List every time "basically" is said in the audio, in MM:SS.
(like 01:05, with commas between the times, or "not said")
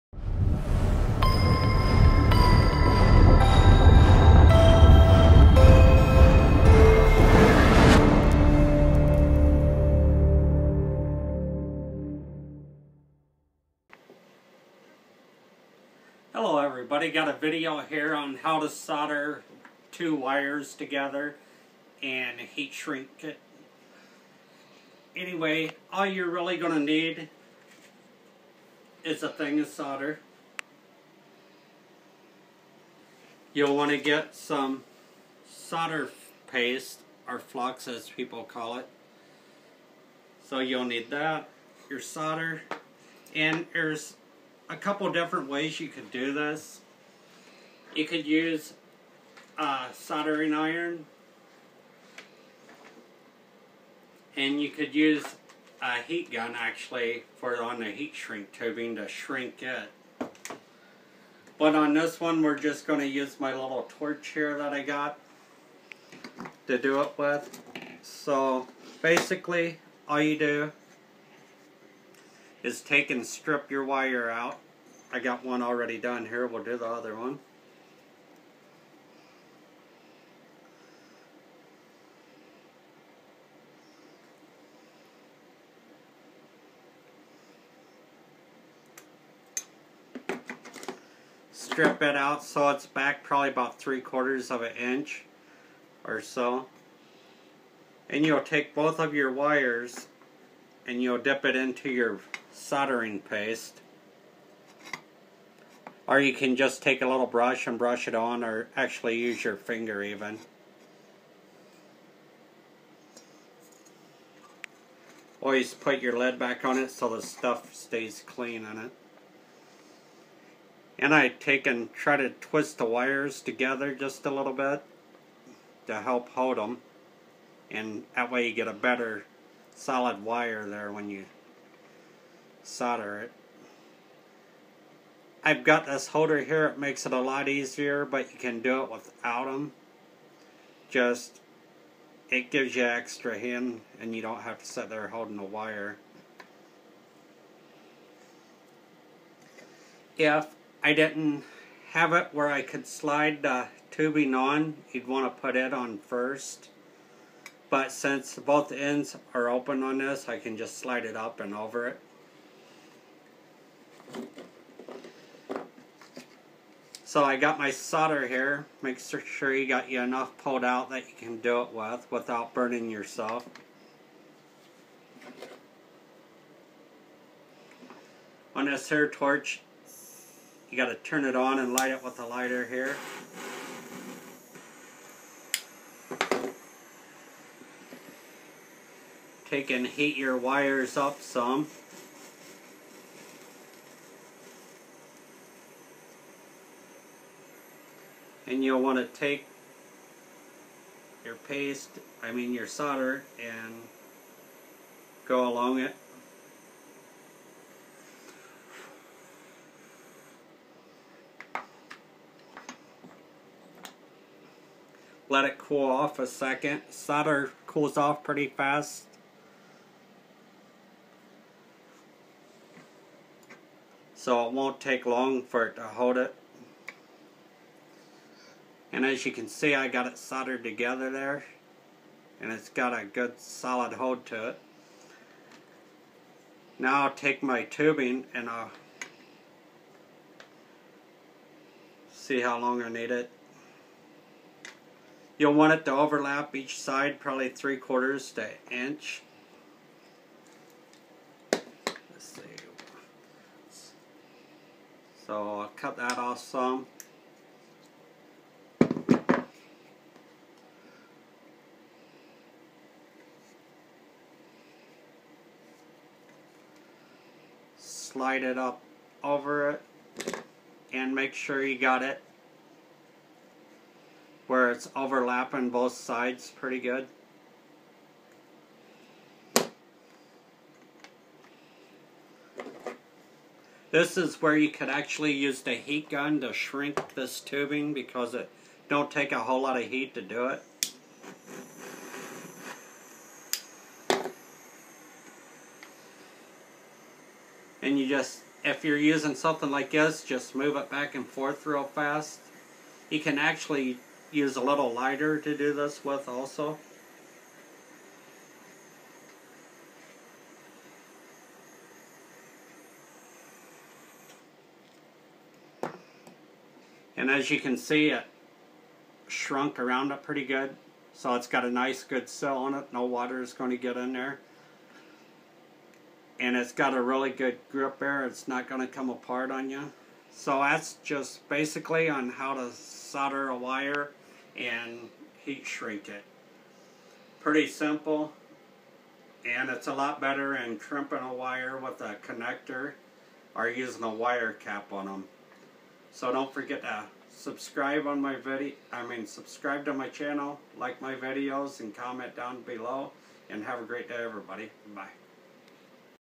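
01:09, 05:31.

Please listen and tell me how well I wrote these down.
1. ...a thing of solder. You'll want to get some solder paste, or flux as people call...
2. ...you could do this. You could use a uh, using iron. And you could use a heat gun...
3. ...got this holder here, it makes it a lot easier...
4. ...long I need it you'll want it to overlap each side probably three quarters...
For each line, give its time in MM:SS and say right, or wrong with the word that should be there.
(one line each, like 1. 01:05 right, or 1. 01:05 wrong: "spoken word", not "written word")
1. 00:29 right
2. 00:45 wrong: "soldering", not "using"
3. 02:15 right
4. 04:02 right.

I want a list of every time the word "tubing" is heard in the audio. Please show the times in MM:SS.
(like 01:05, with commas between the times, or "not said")
00:58, 02:33, 03:57, 04:47.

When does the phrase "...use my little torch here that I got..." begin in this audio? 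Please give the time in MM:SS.
01:03.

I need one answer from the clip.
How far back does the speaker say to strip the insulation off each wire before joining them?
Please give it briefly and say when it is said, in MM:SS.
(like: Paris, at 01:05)
3/4 of an inch, at 01:33.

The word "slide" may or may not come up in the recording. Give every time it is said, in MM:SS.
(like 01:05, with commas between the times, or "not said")
02:32, 02:40, 04:27.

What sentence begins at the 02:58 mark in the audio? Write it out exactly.
On this here torch, you got to turn it on and light it with a lighter here.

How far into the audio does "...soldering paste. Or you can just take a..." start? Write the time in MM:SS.
01:42.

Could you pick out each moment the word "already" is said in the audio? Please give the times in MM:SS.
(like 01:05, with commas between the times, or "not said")
01:15.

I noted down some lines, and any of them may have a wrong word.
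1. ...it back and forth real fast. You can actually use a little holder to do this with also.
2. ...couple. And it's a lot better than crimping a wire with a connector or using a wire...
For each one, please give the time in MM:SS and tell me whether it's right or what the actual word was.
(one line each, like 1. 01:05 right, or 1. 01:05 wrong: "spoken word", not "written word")
1. 05:00 wrong: "lighter", not "holder"
2. 05:37 wrong: "simple", not "couple".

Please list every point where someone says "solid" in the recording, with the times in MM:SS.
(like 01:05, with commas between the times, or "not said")
02:09, 03:53.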